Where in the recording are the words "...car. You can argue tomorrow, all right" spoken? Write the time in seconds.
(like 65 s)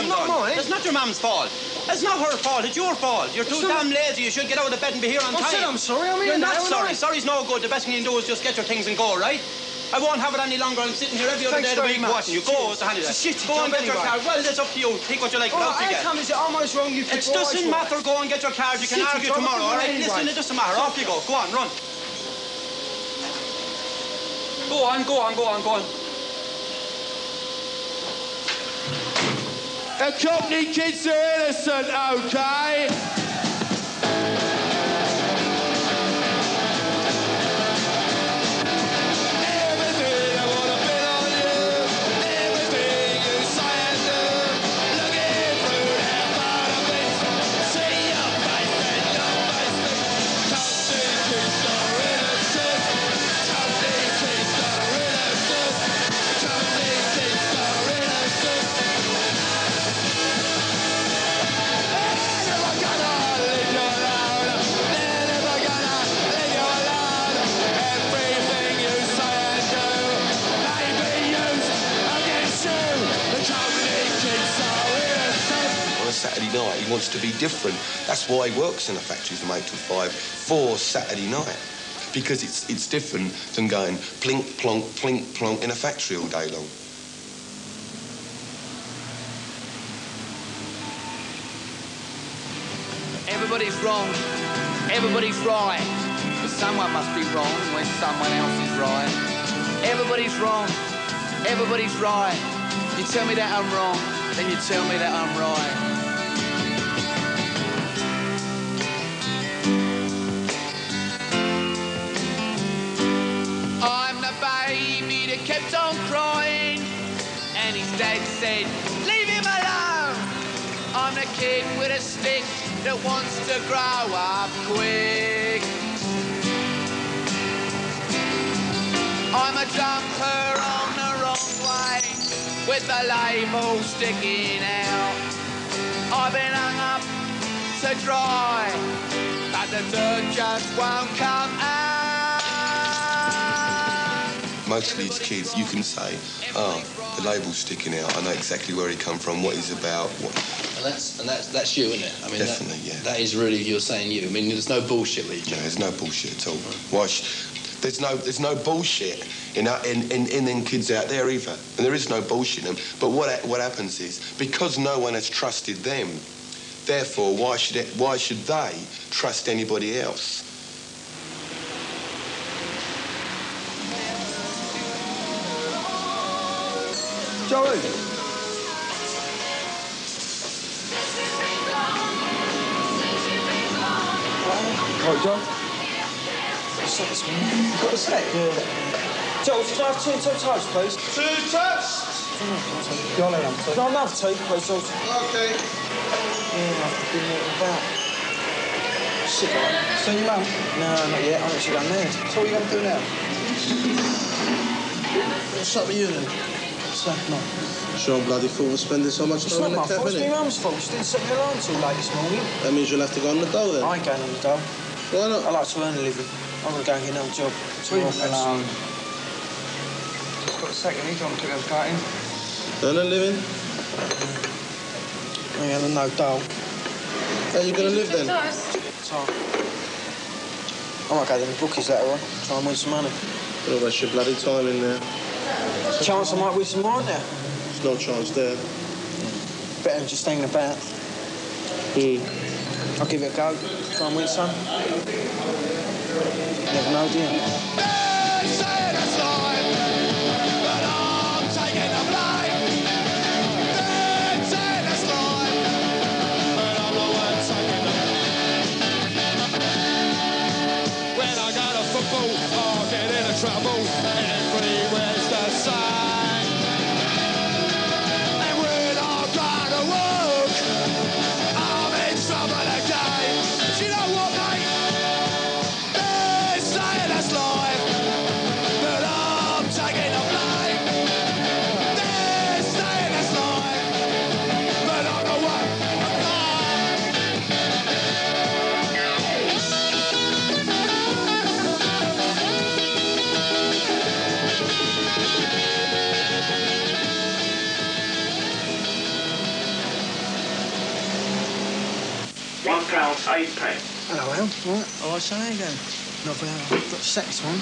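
18 s.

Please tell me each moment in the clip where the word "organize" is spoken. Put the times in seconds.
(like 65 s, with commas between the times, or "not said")
not said.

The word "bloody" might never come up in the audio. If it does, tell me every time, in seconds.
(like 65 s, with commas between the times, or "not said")
208 s, 234 s.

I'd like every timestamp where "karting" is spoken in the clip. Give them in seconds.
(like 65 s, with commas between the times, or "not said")
221 s.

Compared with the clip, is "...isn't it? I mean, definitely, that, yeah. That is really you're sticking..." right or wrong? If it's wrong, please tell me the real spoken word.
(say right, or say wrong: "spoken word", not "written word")
wrong: "saying", not "sticking".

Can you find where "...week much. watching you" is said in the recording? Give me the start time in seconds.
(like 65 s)
11 s.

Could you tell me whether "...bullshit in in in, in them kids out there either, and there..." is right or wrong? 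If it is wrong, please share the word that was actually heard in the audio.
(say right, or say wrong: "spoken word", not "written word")
right.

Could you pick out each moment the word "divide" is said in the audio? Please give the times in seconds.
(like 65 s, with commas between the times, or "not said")
not said.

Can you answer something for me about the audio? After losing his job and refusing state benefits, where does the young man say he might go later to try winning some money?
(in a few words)
the bookies.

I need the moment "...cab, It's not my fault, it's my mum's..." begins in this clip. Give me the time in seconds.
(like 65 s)
209 s.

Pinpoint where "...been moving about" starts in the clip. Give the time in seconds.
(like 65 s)
197 s.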